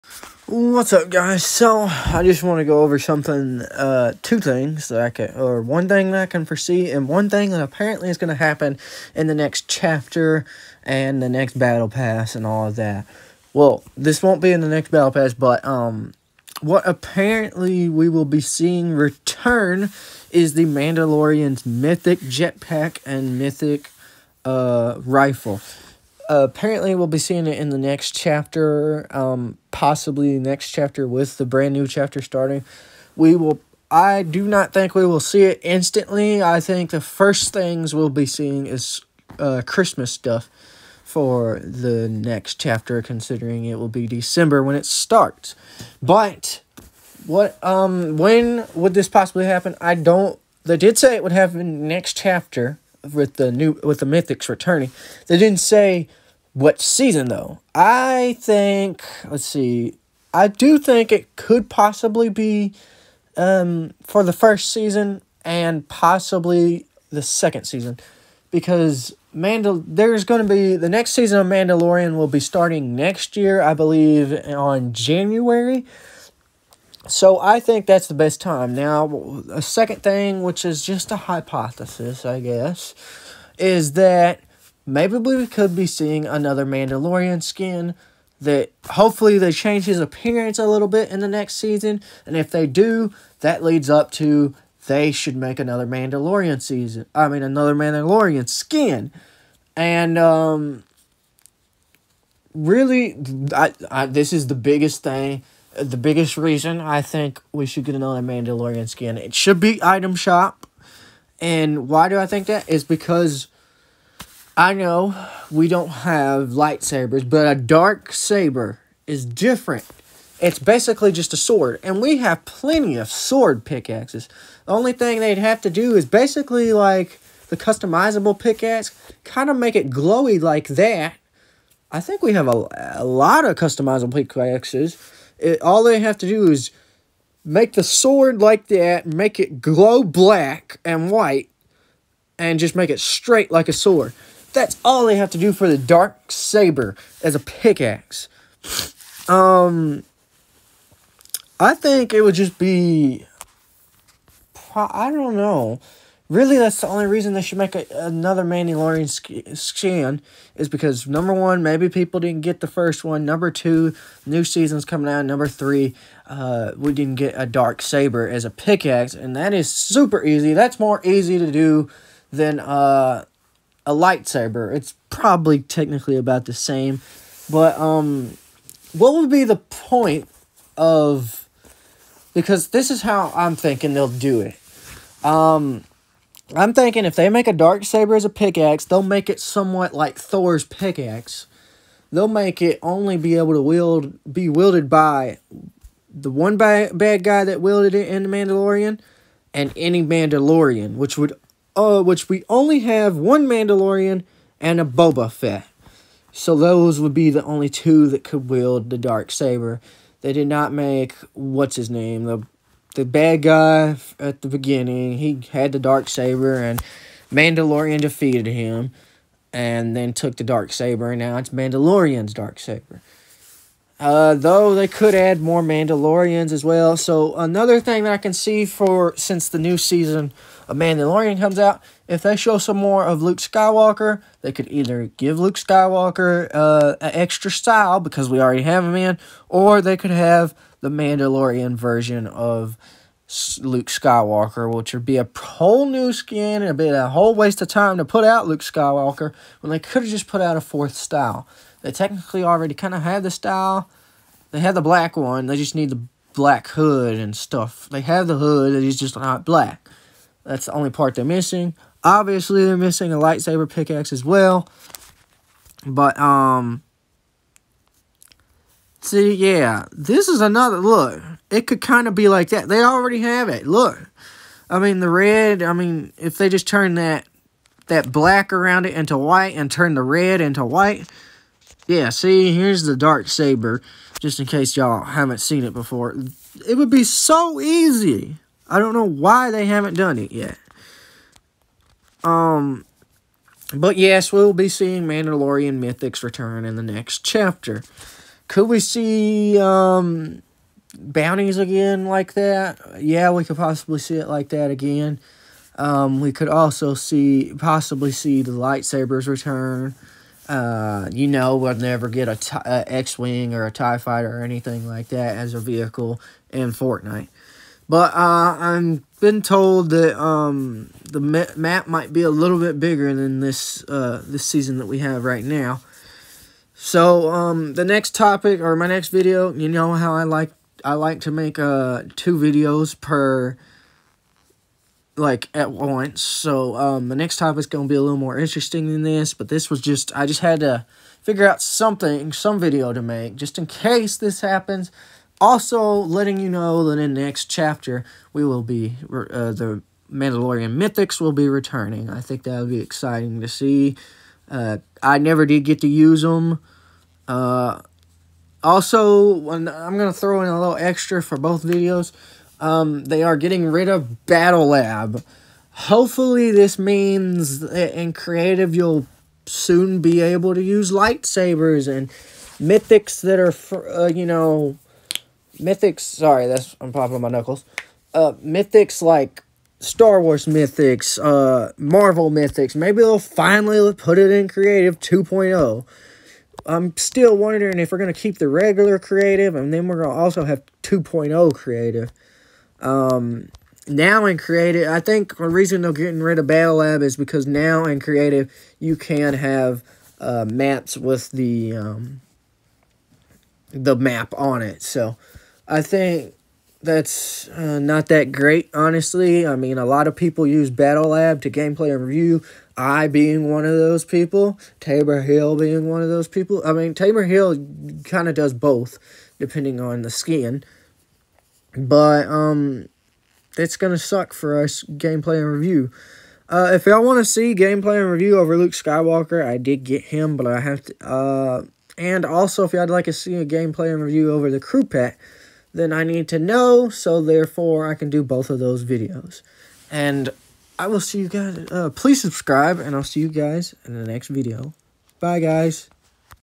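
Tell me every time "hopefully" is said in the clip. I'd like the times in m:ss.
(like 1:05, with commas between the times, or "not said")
1:28, 6:05.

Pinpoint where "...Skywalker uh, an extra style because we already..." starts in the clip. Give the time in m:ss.
3:55.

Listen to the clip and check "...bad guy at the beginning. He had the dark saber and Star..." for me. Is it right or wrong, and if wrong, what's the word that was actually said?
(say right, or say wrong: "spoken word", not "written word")
wrong: "Mandalorian", not "Star".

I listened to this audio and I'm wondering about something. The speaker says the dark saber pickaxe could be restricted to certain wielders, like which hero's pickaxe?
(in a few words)
Thor.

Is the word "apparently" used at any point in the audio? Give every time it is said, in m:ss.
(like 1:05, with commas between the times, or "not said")
0:07, 0:16, 0:26.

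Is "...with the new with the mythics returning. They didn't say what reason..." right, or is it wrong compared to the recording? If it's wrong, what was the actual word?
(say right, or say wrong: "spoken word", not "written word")
wrong: "season", not "reason".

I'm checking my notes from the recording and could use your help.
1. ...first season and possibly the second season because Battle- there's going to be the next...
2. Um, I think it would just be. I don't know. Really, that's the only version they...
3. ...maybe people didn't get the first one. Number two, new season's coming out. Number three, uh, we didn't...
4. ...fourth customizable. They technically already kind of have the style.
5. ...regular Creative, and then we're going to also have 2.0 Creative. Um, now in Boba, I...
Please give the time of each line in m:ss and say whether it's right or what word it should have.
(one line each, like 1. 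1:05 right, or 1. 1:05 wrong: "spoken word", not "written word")
1. 1:04 wrong: "Mandal", not "Battle"
2. 2:29 wrong: "reason", not "version"
3. 2:41 right
4. 4:10 wrong: "style", not "customizable"
5. 6:28 wrong: "Creative", not "Boba".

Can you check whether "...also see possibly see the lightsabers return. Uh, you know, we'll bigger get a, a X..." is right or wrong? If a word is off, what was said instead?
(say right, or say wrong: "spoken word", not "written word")
wrong: "never", not "bigger".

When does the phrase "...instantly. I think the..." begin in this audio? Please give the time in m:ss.
0:35.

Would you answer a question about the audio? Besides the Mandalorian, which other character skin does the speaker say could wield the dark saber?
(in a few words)
Boba Fett.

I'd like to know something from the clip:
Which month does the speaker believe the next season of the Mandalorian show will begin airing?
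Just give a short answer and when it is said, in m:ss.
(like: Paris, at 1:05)
January, at 1:14.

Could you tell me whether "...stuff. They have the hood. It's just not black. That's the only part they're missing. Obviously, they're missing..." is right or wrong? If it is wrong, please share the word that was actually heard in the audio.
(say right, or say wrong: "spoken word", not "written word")
right.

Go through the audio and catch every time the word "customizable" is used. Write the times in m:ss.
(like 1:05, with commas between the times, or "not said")
2:07, 2:13.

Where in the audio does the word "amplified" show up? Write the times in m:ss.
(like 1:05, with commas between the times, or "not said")
not said.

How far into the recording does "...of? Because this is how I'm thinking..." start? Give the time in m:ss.
3:00.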